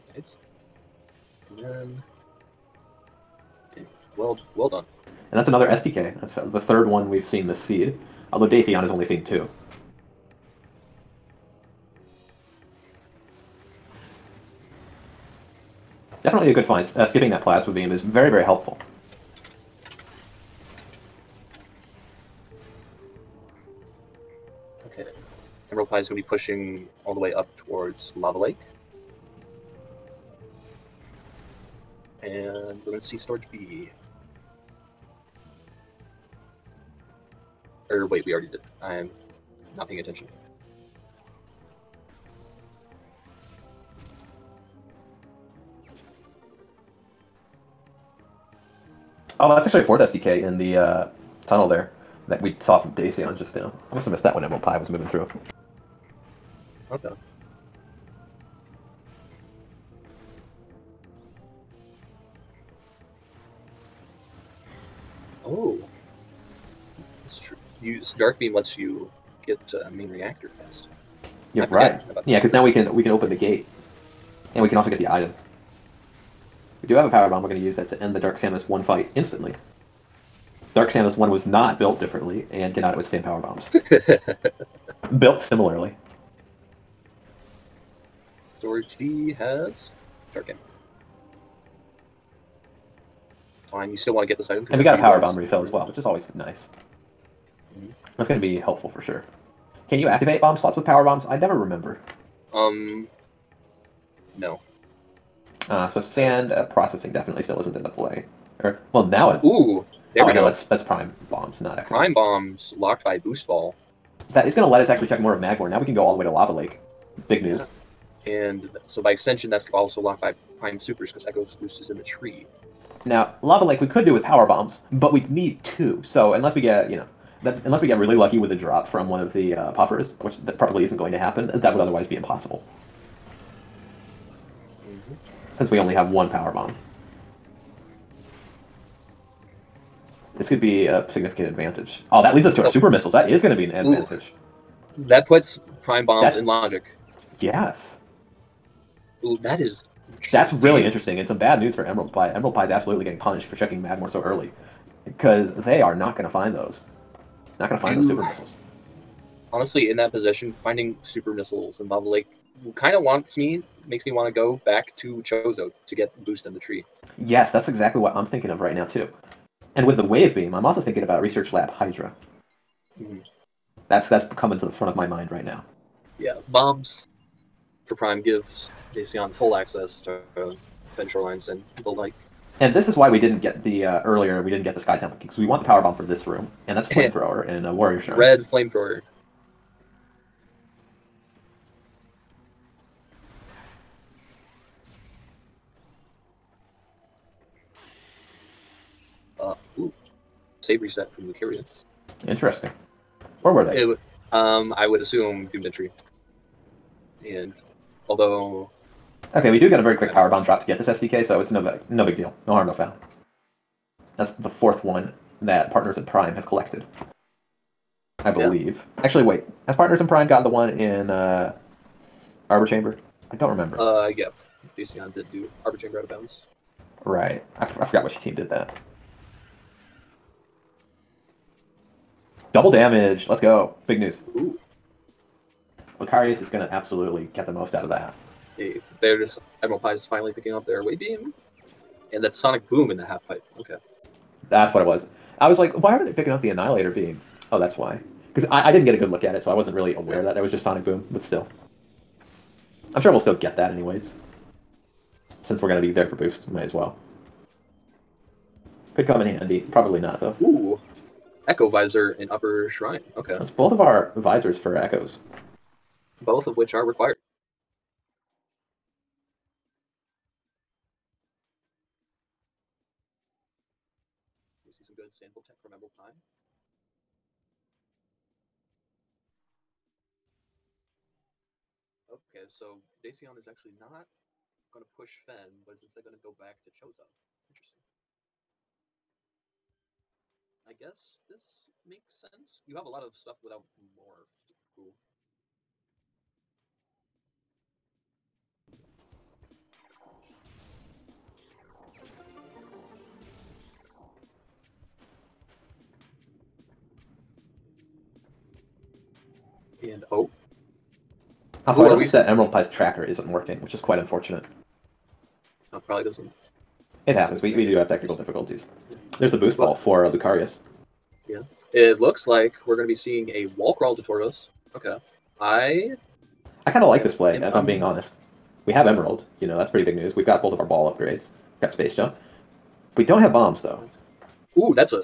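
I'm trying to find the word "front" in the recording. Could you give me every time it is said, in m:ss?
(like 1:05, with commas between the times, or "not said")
2:54.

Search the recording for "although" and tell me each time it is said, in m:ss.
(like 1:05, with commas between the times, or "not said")
0:08, 3:28.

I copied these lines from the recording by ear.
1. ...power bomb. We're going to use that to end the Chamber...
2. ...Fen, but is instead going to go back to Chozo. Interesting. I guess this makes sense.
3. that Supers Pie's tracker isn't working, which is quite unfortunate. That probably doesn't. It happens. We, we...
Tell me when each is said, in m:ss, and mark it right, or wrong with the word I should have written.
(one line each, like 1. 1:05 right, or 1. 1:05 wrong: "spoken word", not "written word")
1. 1:17 wrong: "Dark", not "Chamber"
2. 4:45 right
3. 5:12 wrong: "Emerald", not "Supers".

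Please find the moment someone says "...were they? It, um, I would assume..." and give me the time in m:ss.
3:23.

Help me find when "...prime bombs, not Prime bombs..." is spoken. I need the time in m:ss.
1:50.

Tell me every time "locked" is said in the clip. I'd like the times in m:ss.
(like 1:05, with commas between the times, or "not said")
1:52, 2:00.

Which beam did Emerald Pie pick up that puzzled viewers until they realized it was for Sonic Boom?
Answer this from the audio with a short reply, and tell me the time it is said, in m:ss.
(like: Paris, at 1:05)
Annihilator beam, at 4:06.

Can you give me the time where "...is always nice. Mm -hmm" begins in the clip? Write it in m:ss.
1:35.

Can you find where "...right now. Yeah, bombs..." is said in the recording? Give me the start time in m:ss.
2:55.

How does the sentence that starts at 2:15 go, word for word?
since we only have one power bomb.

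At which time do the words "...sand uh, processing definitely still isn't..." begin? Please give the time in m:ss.
1:46.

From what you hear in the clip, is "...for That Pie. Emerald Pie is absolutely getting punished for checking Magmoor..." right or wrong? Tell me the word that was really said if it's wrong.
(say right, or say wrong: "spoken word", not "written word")
wrong: "Emerald", not "That".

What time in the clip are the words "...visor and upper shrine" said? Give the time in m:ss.
4:21.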